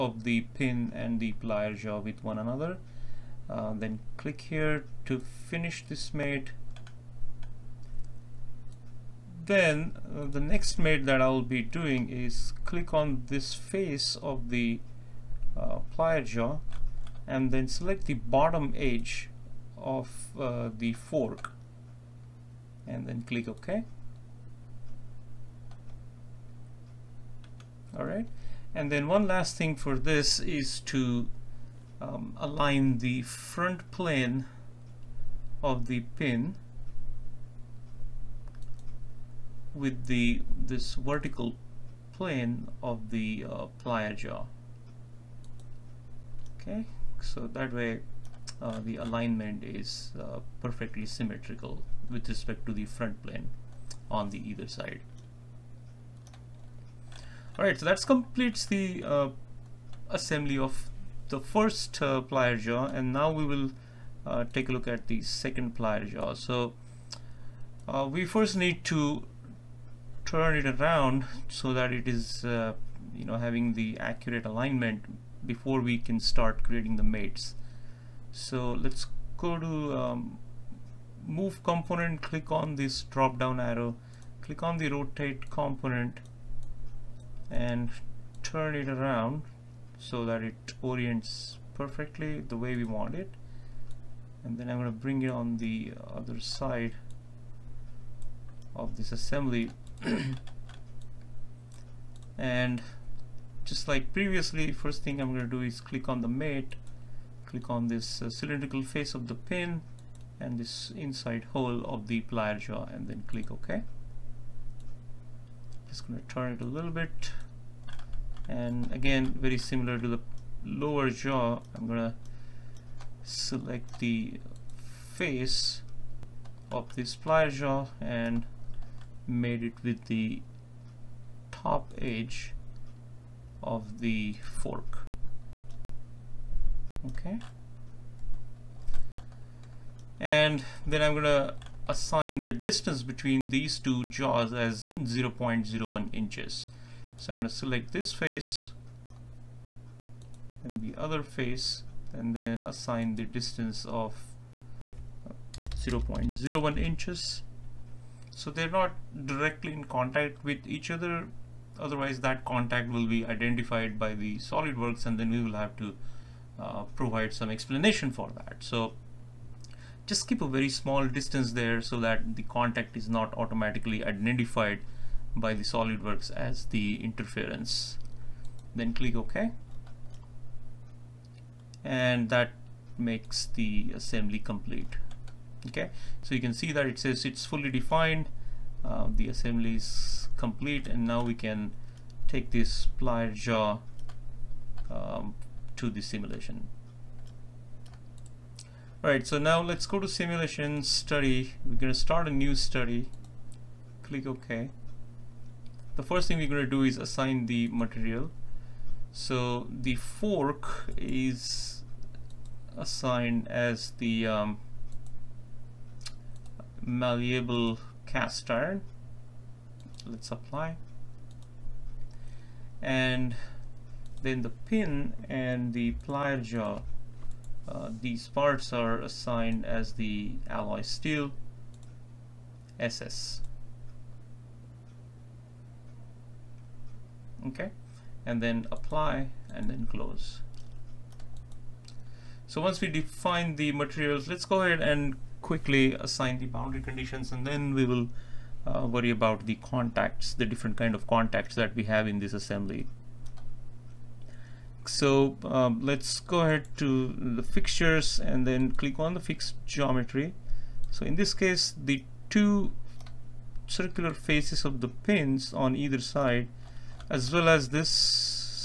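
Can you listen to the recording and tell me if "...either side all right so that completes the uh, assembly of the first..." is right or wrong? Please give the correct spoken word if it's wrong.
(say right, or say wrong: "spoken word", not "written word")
right.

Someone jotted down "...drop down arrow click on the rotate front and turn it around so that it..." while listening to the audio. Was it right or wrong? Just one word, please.
wrong.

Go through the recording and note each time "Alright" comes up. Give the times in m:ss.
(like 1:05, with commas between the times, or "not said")
0:27, 3:19.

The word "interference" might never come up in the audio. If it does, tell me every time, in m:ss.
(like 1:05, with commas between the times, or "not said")
2:57.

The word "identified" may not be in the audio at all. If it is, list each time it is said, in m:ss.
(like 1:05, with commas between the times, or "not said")
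2:43, 2:54.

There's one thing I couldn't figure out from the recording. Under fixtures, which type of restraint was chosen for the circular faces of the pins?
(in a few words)
fixed geometry.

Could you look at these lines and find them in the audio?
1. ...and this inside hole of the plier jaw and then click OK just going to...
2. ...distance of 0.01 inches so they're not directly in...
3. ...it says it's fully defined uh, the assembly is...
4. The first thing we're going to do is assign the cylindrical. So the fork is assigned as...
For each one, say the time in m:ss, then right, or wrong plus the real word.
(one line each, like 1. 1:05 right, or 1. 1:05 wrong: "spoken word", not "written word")
1. 1:50 right
2. 2:33 right
3. 3:06 right
4. 3:25 wrong: "material", not "cylindrical".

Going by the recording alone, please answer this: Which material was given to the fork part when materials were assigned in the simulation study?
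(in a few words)
malleable cast iron.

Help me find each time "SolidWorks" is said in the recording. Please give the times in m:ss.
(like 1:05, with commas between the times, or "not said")
2:44, 2:55.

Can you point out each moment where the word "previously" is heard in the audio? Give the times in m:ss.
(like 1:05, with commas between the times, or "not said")
1:44.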